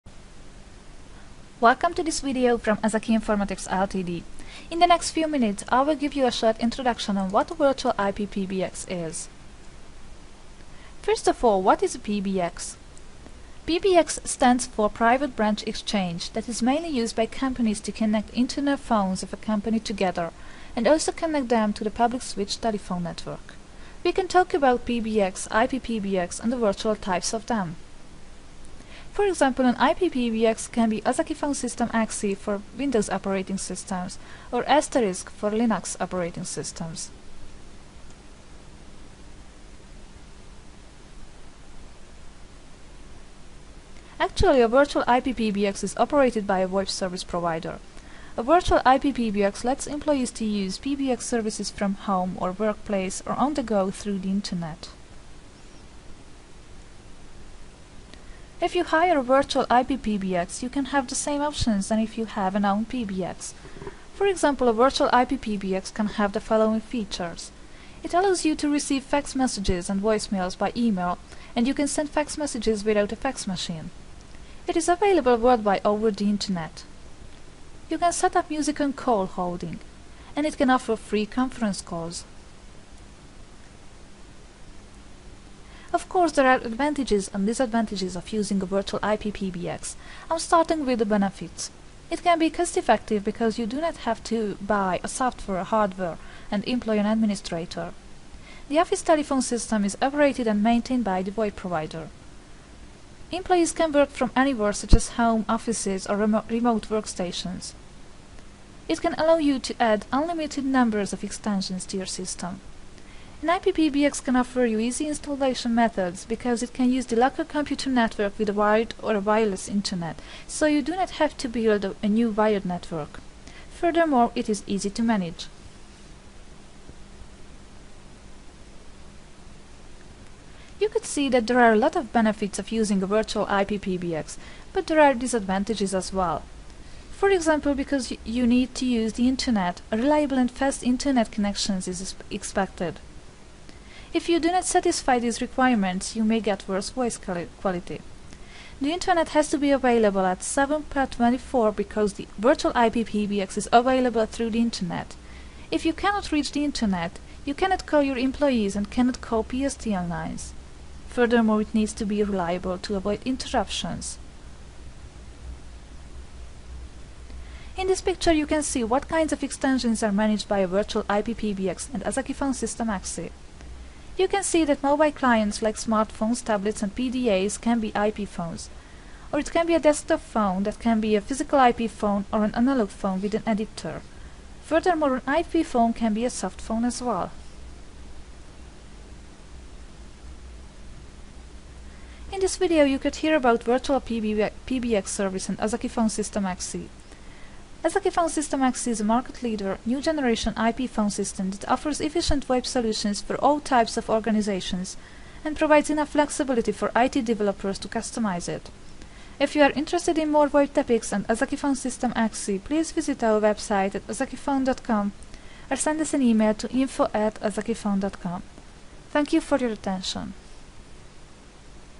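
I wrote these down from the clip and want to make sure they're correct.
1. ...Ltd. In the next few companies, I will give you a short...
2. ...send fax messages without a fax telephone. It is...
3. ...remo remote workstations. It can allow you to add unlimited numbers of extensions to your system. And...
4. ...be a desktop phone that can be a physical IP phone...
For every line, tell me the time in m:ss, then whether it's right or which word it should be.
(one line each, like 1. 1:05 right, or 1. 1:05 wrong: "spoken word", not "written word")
1. 0:03 wrong: "minutes", not "companies"
2. 1:11 wrong: "machine", not "telephone"
3. 1:46 right
4. 2:59 right.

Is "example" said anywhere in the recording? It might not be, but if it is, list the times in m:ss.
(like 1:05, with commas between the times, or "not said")
0:29, 1:04, 2:17.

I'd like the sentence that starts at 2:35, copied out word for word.
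If you cannot reach the internet, you cannot call your employees and cannot call PSTN lines.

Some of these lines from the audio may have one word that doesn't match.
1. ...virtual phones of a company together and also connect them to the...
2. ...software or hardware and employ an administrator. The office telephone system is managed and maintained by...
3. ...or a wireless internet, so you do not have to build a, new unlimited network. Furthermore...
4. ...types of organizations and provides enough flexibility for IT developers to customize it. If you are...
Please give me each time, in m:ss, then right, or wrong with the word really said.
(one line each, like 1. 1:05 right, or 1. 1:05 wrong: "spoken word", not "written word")
1. 0:18 wrong: "internal", not "virtual"
2. 1:35 wrong: "operated", not "managed"
3. 1:59 wrong: "wired", not "unlimited"
4. 3:23 right.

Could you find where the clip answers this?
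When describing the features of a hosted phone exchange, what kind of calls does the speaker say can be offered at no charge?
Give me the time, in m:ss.
1:21.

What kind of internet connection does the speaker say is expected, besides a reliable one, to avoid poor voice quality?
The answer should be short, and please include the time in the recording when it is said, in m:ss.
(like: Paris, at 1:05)
fast, at 2:20.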